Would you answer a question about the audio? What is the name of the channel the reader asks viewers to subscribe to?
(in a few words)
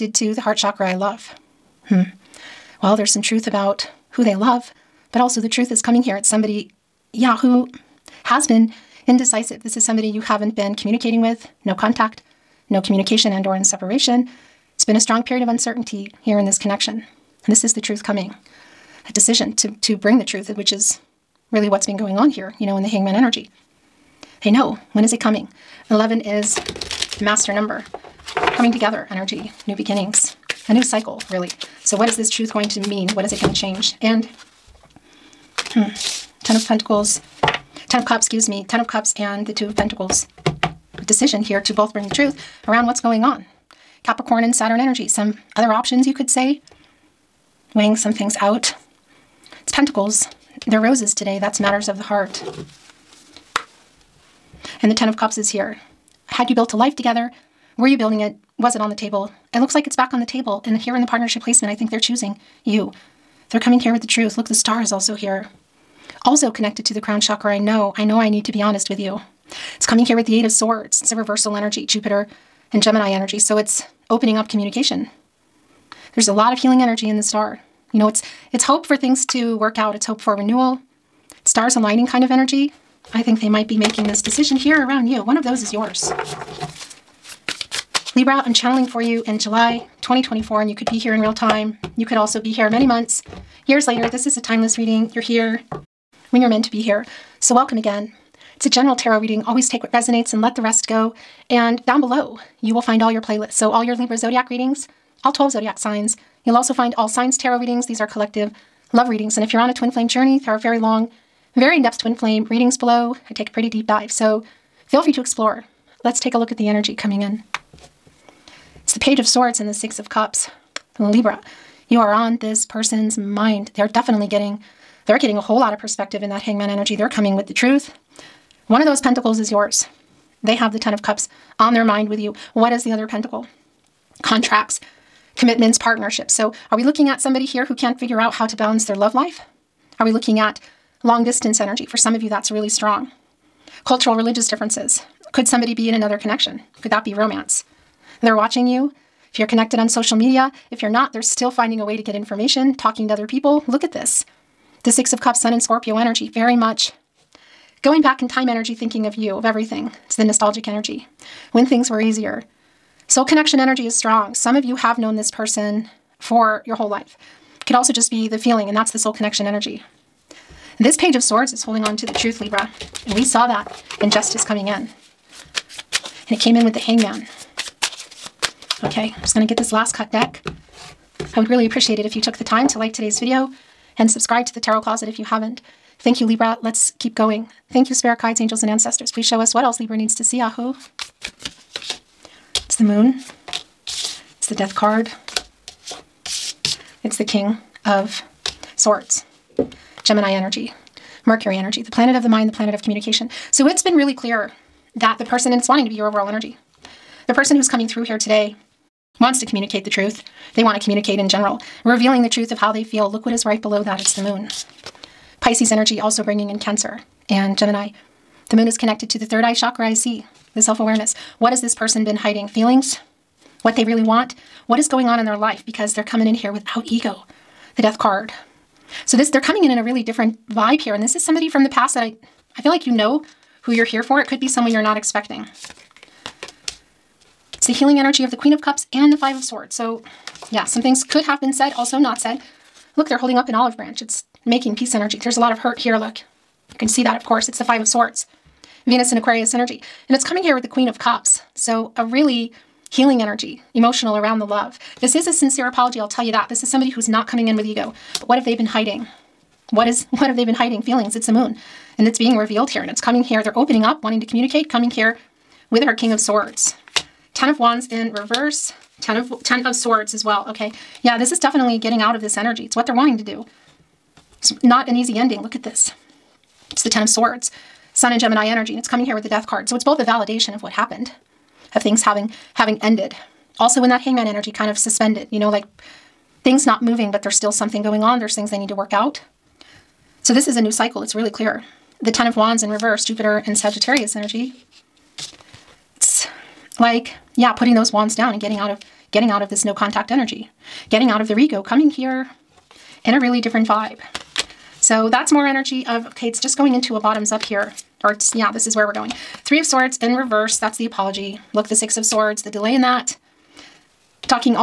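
Tarot Closet.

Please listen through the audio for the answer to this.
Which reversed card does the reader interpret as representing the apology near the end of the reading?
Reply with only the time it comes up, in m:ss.
5:09.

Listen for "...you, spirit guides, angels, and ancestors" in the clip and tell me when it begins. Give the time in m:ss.
3:07.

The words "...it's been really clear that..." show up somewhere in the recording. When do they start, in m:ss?
3:23.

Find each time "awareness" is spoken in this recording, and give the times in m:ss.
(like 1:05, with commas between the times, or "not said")
3:40.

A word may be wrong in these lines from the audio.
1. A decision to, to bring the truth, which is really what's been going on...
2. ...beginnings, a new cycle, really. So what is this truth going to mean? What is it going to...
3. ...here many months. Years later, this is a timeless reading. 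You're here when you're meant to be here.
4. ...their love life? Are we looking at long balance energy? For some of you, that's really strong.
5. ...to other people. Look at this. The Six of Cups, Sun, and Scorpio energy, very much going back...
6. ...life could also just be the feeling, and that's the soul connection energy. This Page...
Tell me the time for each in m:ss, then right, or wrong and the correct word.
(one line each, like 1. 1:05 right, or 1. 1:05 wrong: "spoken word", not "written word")
1. 0:19 right
2. 0:29 right
3. 1:32 right
4. 2:18 wrong: "distance", not "balance"
5. 2:33 right
6. 2:46 right.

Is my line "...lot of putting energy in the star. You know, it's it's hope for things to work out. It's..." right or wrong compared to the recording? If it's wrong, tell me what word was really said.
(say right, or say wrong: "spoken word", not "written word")
wrong: "healing", not "putting".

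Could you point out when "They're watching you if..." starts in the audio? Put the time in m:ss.
2:28.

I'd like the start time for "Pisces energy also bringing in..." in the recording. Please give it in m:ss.
3:35.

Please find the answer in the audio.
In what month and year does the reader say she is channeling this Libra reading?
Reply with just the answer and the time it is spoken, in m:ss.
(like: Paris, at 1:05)
July 2024, at 1:29.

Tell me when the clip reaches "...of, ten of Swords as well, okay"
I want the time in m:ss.
4:29.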